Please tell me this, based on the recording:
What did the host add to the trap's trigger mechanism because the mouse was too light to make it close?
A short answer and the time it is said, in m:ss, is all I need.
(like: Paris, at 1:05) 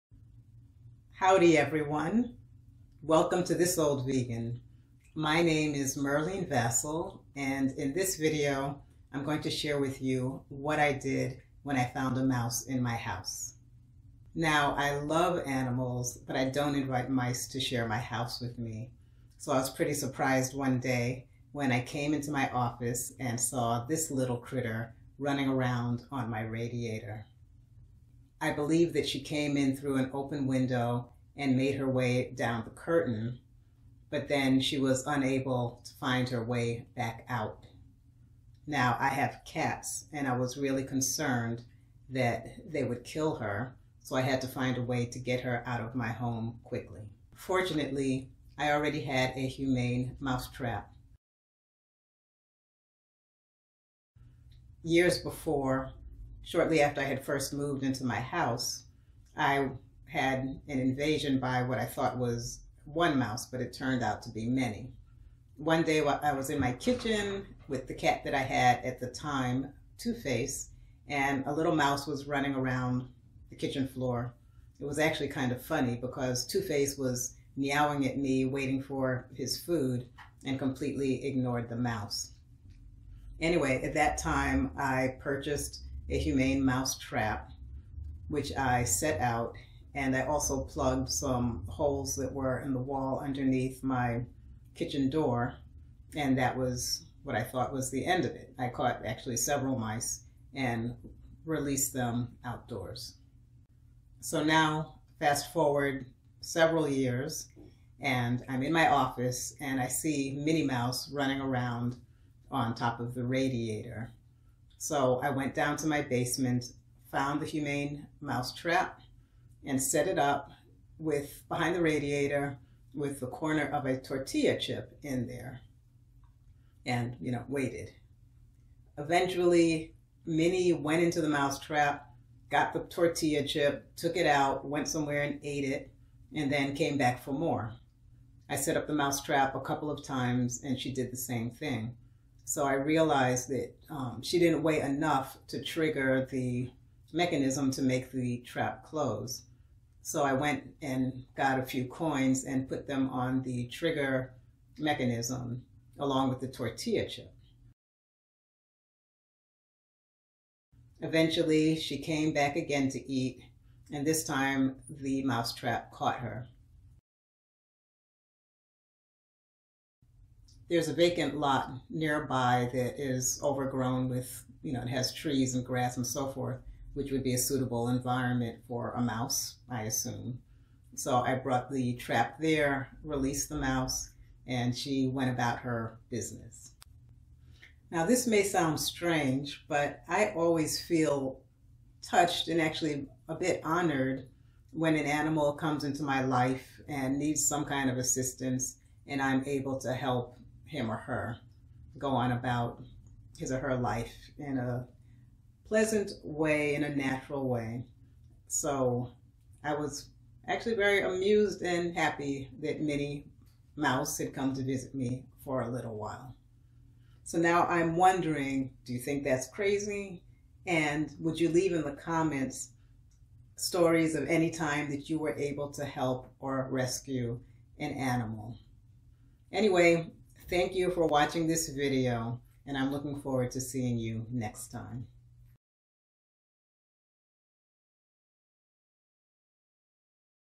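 Coins, at 2:31.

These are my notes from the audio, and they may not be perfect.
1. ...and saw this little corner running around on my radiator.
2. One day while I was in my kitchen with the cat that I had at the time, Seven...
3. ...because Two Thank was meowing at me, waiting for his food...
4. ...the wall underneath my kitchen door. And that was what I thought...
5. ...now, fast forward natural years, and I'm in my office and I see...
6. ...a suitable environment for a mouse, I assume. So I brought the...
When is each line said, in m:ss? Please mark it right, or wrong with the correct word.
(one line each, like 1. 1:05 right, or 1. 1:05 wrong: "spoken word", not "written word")
1. 0:23 wrong: "critter", not "corner"
2. 1:05 wrong: "Two", not "Seven"
3. 1:15 wrong: "Face", not "Thank"
4. 1:32 right
5. 1:44 wrong: "several", not "natural"
6. 2:57 right.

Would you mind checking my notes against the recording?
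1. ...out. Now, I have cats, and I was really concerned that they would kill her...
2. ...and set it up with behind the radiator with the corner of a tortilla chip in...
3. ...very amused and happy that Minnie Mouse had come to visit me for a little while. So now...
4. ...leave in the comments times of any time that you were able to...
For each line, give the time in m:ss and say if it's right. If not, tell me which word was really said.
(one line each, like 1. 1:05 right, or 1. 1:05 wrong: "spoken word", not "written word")
1. 0:37 right
2. 1:59 right
3. 3:30 right
4. 3:41 wrong: "stories", not "times".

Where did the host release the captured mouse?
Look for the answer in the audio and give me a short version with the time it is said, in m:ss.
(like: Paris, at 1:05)
Vacant lot, at 2:50.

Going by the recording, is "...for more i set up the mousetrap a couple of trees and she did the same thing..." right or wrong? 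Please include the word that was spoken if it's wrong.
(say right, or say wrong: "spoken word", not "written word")
wrong: "times", not "trees".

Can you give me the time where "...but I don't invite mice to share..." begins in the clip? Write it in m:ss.
0:16.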